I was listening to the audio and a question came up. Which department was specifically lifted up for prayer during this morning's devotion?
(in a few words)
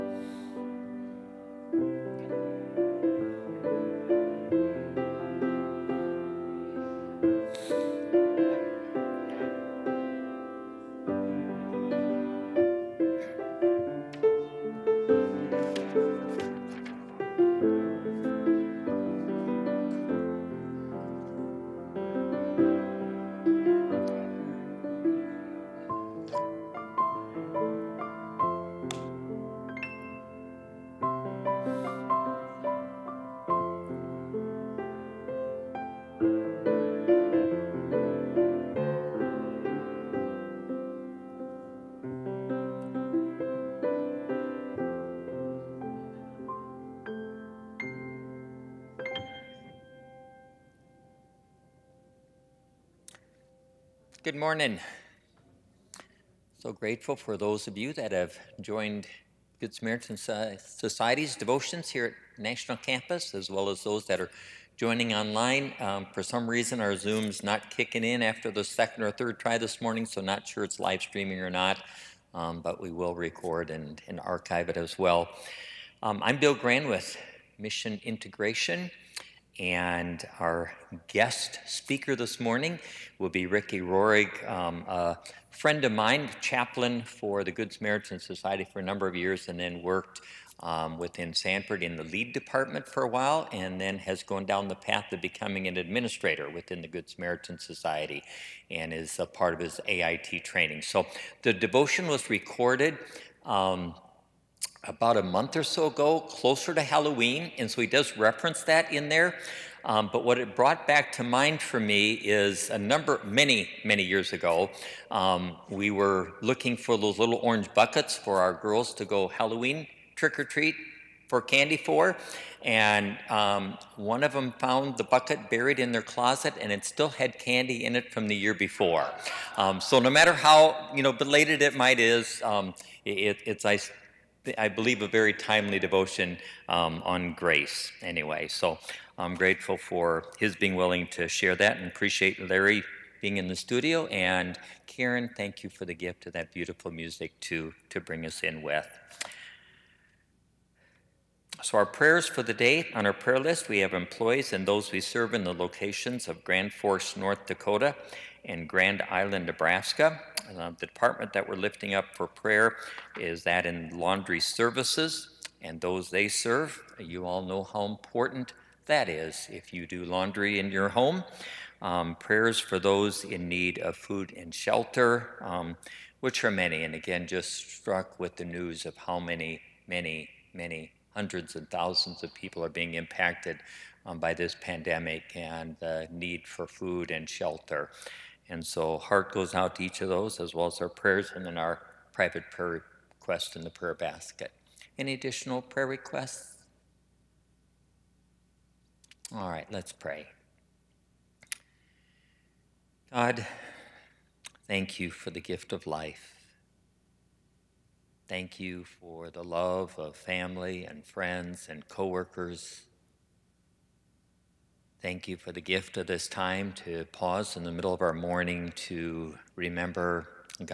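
laundry services.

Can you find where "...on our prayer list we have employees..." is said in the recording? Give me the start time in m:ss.
2:32.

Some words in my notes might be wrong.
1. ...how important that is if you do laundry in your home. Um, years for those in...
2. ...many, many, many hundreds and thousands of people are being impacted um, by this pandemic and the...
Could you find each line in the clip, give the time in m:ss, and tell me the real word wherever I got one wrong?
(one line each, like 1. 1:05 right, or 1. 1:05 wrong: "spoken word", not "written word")
1. 2:47 wrong: "prayers", not "years"
2. 2:59 right.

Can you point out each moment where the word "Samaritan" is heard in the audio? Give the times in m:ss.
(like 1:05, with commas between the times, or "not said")
0:59, 1:27, 1:37.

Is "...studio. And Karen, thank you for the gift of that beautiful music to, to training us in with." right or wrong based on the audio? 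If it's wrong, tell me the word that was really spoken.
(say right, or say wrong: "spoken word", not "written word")
wrong: "bring", not "training".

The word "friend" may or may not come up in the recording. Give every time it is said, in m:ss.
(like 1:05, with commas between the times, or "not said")
1:25, 3:31.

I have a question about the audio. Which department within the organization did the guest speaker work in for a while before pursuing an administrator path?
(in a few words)
lead department.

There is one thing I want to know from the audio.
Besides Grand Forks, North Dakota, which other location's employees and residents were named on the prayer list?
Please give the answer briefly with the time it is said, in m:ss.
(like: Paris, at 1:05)
Grand Island, Nebraska, at 2:38.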